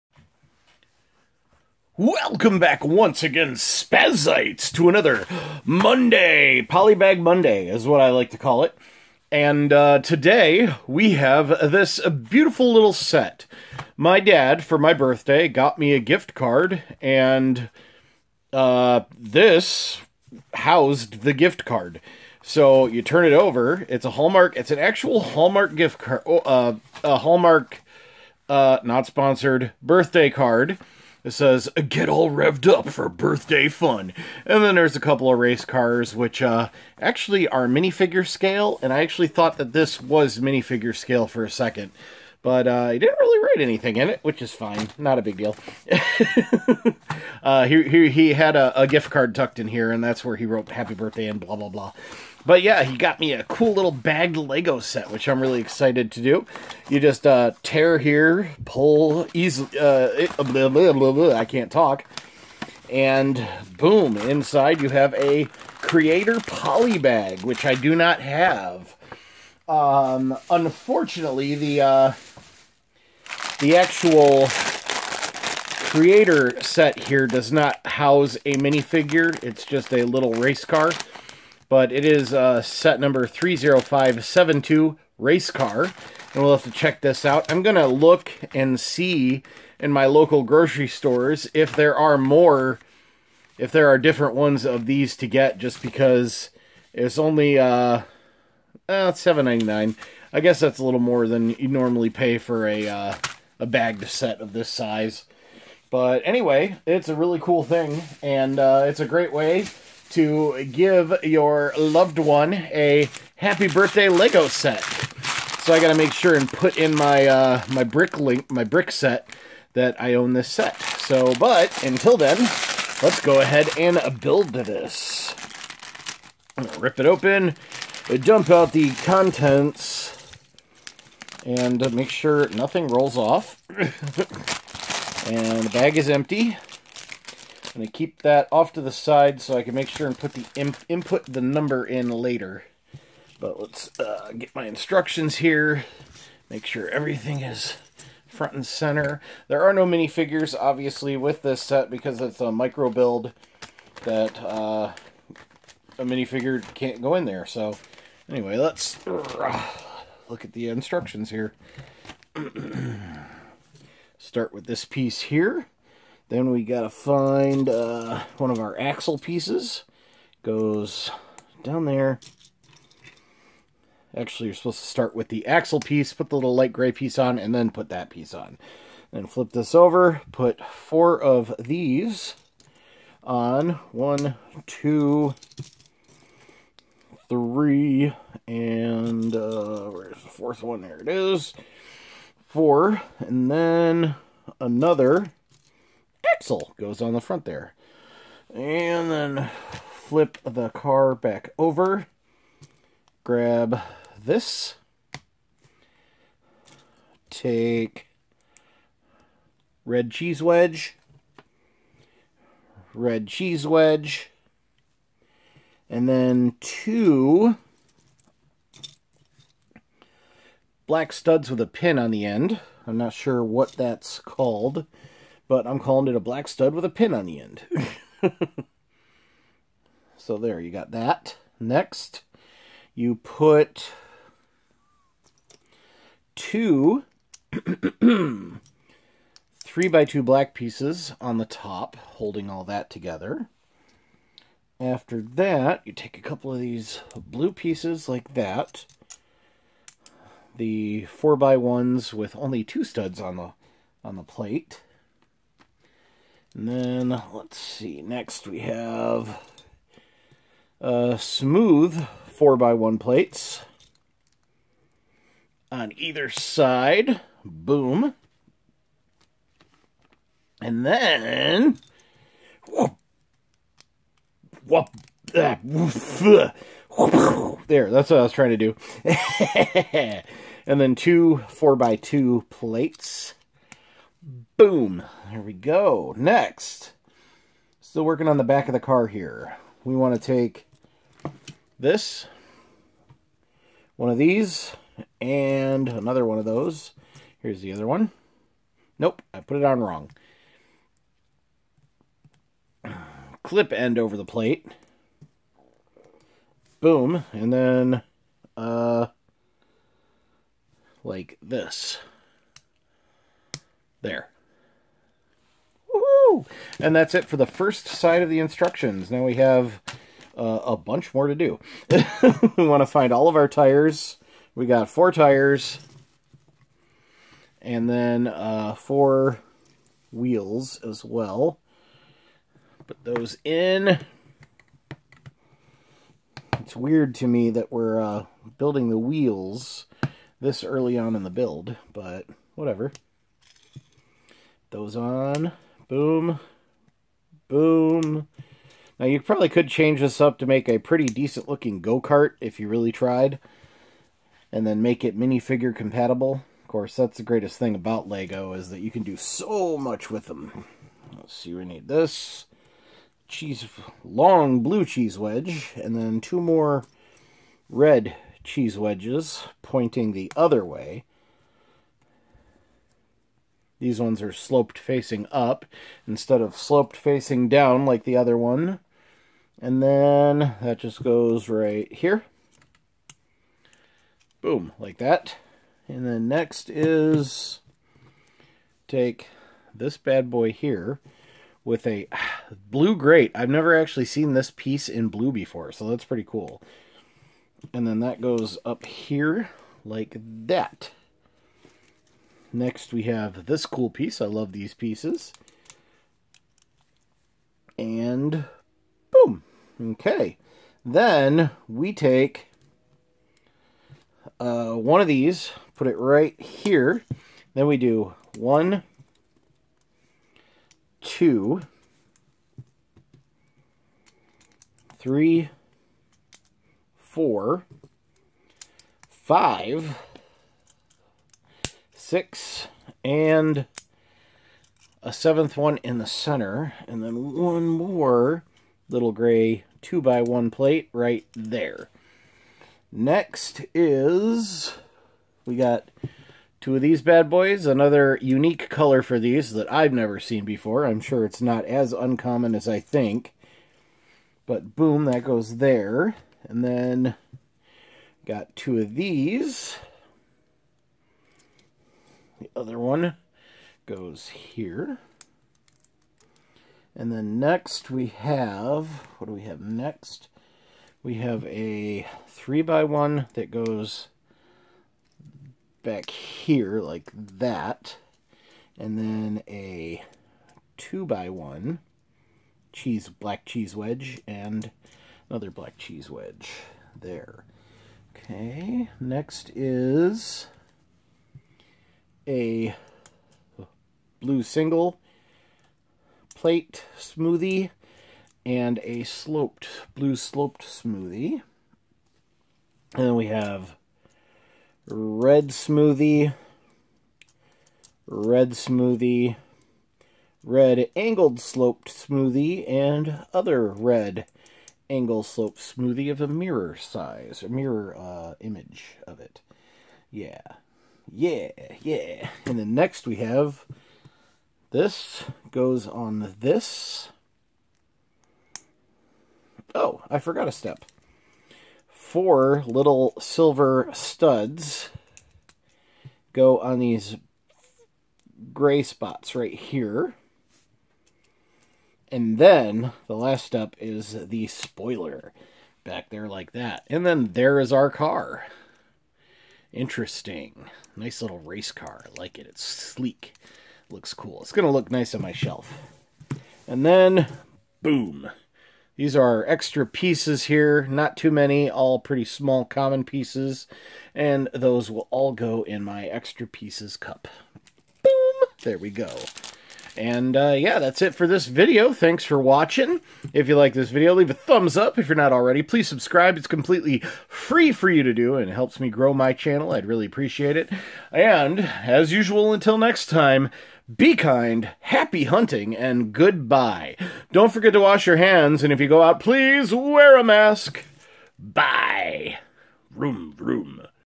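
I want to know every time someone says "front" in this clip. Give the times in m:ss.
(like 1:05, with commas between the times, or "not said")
2:28, 3:17.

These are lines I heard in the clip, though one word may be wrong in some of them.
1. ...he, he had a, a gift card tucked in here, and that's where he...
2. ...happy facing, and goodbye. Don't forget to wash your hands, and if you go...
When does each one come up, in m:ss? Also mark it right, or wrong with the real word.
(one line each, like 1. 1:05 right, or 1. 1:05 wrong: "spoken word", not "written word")
1. 0:47 right
2. 9:44 wrong: "hunting", not "facing".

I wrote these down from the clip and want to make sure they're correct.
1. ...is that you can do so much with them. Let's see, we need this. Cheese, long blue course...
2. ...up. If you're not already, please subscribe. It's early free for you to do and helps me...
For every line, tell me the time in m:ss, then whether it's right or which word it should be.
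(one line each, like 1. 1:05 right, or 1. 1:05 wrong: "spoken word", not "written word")
1. 5:58 wrong: "cheese", not "course"
2. 9:34 wrong: "completely", not "early".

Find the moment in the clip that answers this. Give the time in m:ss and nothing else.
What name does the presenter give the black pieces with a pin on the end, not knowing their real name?
3:46.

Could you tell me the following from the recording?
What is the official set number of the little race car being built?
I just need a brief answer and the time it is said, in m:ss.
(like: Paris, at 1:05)
30572, at 1:23.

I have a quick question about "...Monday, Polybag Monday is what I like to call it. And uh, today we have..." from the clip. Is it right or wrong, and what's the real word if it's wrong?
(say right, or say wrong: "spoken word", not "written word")
right.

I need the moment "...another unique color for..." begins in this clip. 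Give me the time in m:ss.
7:27.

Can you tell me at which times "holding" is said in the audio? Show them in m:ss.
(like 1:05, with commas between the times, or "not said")
4:01.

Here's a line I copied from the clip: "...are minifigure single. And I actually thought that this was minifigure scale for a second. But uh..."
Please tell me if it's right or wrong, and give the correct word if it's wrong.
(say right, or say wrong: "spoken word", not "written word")
wrong: "scale", not "single".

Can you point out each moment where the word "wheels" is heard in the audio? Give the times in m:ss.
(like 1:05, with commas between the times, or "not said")
5:30, 5:38.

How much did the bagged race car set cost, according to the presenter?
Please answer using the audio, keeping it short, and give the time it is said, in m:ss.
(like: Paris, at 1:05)
$7.99, at 1:39.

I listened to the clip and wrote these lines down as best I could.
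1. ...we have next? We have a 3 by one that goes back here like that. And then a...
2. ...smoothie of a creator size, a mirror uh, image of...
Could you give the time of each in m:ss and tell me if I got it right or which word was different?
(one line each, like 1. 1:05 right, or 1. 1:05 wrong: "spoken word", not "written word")
1. 7:49 right
2. 8:35 wrong: "mirror", not "creator".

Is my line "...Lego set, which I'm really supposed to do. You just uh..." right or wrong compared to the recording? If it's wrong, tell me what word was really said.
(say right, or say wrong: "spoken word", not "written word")
wrong: "excited", not "supposed".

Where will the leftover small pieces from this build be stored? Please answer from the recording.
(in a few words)
extra pieces cup.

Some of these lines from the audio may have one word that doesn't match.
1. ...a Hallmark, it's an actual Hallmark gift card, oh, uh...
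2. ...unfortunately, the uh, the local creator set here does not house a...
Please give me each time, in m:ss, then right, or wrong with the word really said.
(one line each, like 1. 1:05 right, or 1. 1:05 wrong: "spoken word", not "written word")
1. 0:24 right
2. 1:10 wrong: "actual", not "local".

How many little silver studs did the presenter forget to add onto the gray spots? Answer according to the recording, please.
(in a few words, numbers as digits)
4.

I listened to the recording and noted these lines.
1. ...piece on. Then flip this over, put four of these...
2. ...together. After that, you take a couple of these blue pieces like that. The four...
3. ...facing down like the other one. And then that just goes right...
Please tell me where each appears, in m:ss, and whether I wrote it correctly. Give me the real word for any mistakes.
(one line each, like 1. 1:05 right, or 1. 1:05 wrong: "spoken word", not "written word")
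1. 2:58 right
2. 4:02 right
3. 6:16 right.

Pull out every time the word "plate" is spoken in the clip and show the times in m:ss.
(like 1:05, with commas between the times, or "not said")
4:14, 4:22, 4:42, 5:04, 7:20, 8:16.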